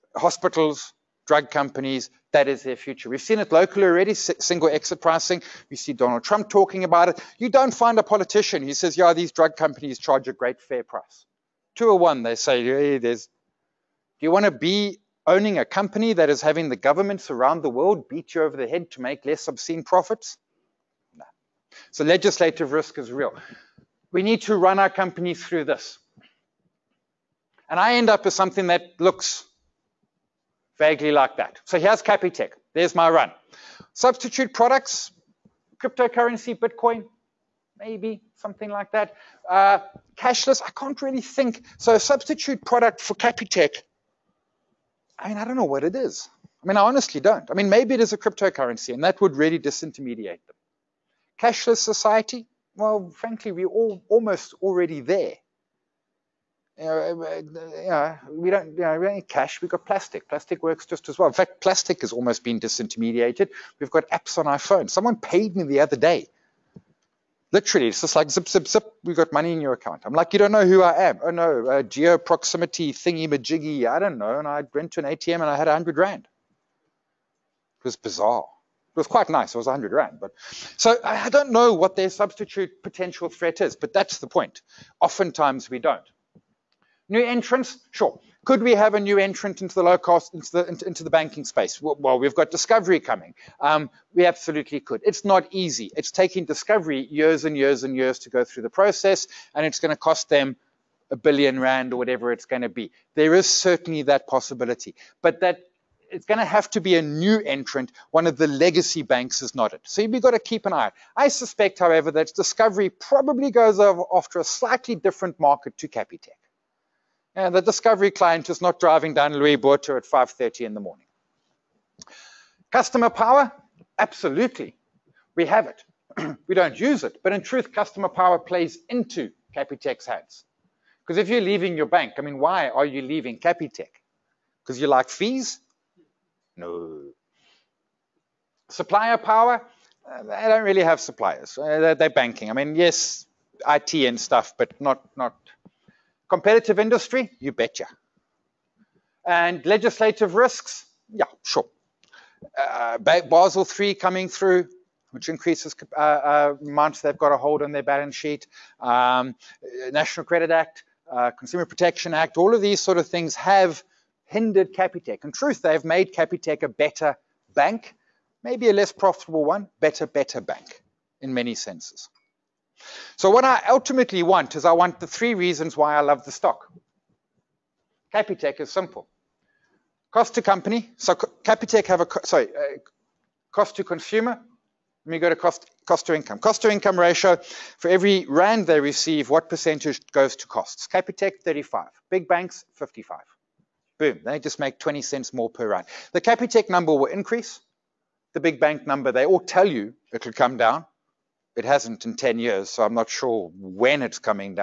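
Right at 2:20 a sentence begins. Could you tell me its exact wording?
Uh, they don't really have suppliers.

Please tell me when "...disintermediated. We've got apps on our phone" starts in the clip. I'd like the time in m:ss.
1:02.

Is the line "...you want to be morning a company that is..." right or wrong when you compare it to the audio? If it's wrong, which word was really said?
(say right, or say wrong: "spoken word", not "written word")
wrong: "owning", not "morning".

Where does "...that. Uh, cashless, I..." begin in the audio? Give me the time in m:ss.
0:38.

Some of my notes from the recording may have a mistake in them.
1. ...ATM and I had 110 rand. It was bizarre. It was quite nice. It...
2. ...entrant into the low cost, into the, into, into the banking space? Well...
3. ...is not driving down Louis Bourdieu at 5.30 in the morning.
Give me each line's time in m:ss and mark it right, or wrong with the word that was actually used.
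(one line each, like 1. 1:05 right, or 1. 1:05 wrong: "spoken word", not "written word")
1. 1:15 wrong: "100", not "110"
2. 1:29 right
3. 1:58 right.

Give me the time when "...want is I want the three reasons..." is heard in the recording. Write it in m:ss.
2:54.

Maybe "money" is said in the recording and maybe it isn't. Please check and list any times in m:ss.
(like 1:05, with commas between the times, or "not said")
1:09.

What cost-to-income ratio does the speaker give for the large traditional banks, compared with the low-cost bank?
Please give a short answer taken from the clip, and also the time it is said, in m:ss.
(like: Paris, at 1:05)
55, at 3:12.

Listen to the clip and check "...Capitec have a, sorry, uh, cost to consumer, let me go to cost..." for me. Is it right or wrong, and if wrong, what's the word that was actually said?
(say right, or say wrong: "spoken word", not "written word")
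right.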